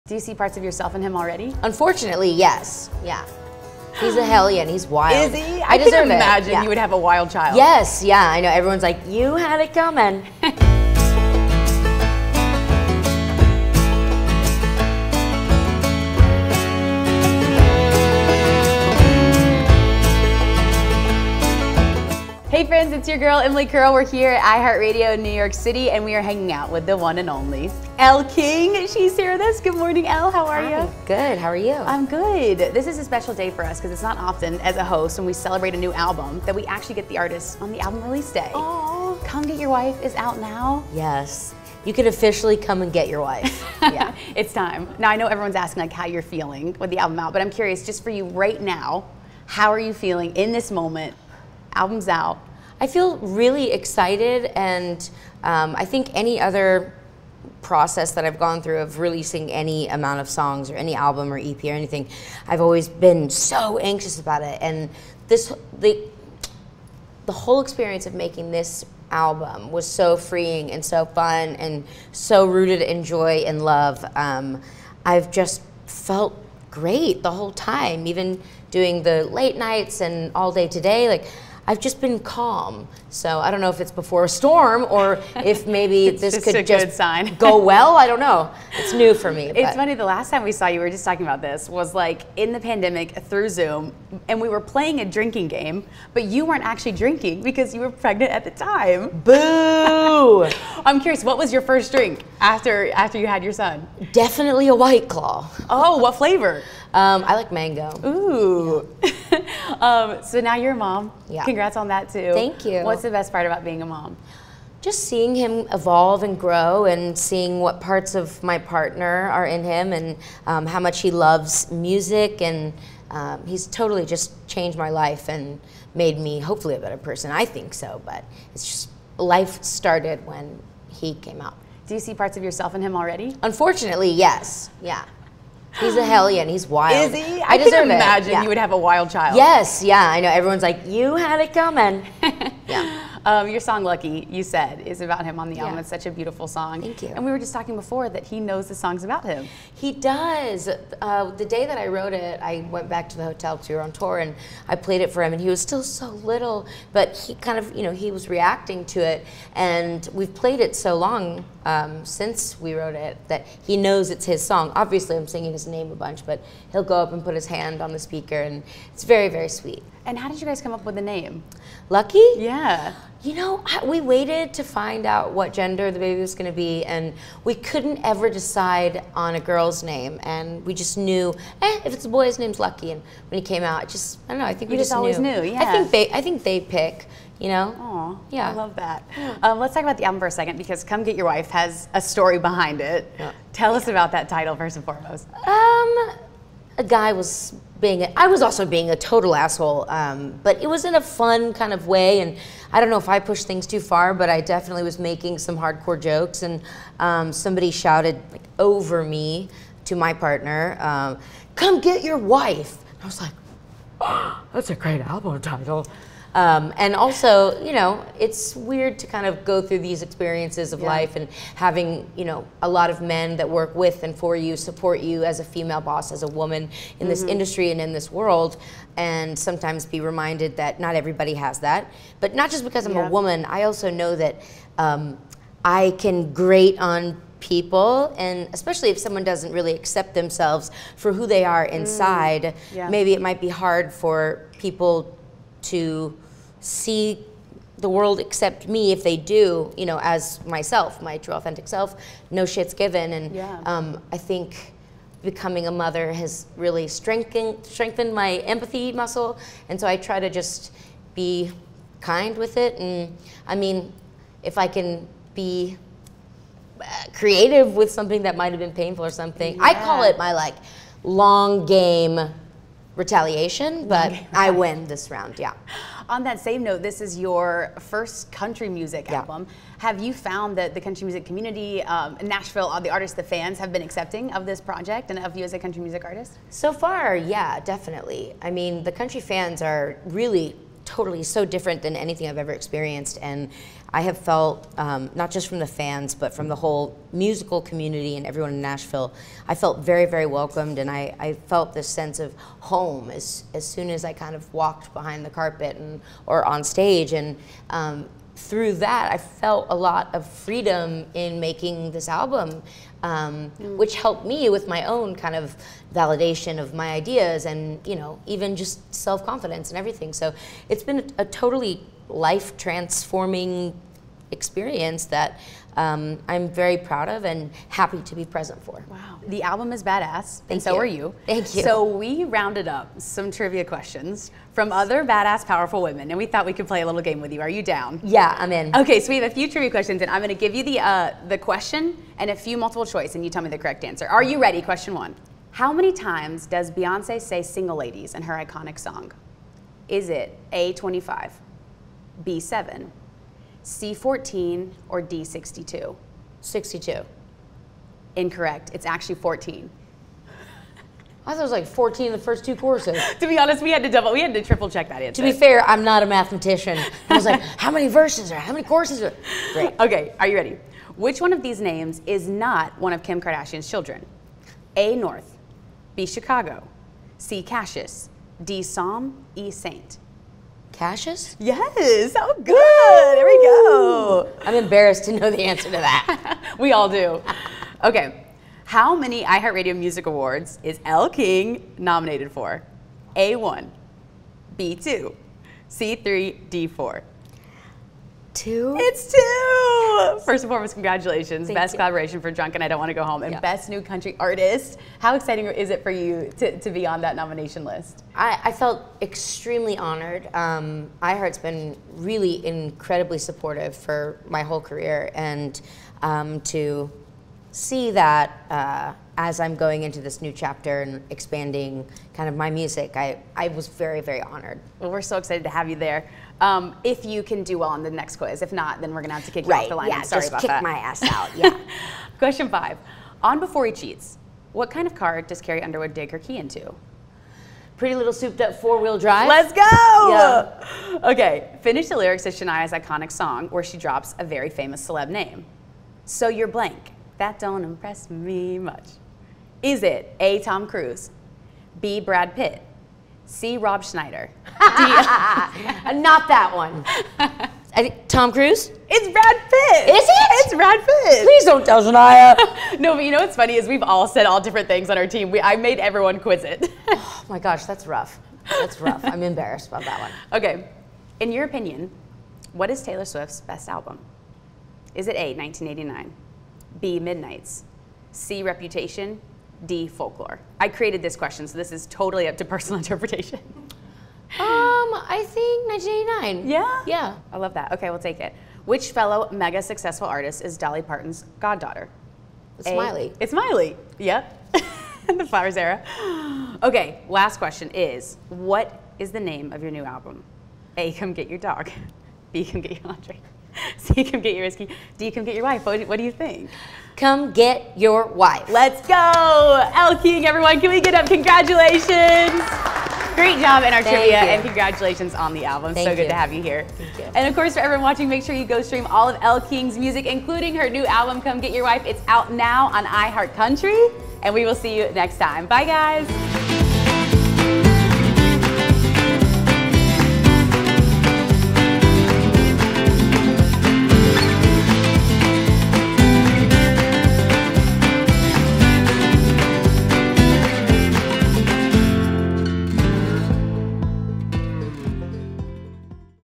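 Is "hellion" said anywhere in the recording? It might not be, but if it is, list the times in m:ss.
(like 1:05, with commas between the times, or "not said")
0:04, 2:16.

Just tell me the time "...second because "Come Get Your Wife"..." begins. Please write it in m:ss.
3:10.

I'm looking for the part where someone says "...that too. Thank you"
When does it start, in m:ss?
1:51.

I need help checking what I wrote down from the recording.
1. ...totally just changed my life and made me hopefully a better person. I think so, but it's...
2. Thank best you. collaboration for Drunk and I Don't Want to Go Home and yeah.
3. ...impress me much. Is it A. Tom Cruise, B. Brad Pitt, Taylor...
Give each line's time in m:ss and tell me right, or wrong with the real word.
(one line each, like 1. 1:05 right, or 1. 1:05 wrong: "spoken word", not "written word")
1. 2:03 right
2. 6:41 right
3. 7:27 wrong: "See", not "Taylor".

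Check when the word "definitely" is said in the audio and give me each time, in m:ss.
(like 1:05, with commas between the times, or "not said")
1:44, 3:24, 4:47.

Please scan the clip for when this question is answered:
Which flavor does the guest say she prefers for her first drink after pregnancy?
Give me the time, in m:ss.
1:47.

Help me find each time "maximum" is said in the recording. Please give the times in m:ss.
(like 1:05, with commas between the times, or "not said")
not said.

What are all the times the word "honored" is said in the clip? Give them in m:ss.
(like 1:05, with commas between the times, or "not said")
6:49, 7:04.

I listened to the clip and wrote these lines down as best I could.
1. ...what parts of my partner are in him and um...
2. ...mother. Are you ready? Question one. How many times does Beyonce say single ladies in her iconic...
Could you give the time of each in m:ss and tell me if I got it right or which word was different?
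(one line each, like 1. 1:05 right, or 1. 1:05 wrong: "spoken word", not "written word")
1. 1:57 right
2. 5:43 wrong: "answer", not "mother".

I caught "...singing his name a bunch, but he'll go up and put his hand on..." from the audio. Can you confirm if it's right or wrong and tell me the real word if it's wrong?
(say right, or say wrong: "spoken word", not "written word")
right.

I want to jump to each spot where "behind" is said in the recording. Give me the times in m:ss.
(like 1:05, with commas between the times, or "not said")
3:12, 5:04.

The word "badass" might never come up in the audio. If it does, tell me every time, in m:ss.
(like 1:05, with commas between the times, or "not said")
5:29, 5:35.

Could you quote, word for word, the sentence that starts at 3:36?
Um, and also, you know, it's weird to kind of go through these experiences of yeah.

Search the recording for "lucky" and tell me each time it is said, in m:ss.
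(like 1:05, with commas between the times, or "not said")
2:23, 2:51, 3:02.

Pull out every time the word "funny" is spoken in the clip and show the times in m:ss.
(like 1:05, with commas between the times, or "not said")
1:29, 7:43.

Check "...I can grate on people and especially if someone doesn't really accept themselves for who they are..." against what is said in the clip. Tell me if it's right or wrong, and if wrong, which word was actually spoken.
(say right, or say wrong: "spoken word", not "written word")
right.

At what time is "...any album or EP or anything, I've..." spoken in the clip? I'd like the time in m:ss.
1:00.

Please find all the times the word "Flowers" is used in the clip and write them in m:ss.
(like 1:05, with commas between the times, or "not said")
8:15.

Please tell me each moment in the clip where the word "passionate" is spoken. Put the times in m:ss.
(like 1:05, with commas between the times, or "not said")
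not said.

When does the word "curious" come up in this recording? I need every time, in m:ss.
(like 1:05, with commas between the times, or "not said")
0:47, 1:40.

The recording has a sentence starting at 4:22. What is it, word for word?
And I mean, if I can be uh, creative with something that might have been painful or something, yeah.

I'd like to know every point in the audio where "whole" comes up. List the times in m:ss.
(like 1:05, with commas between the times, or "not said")
1:07, 1:17, 4:56, 6:54.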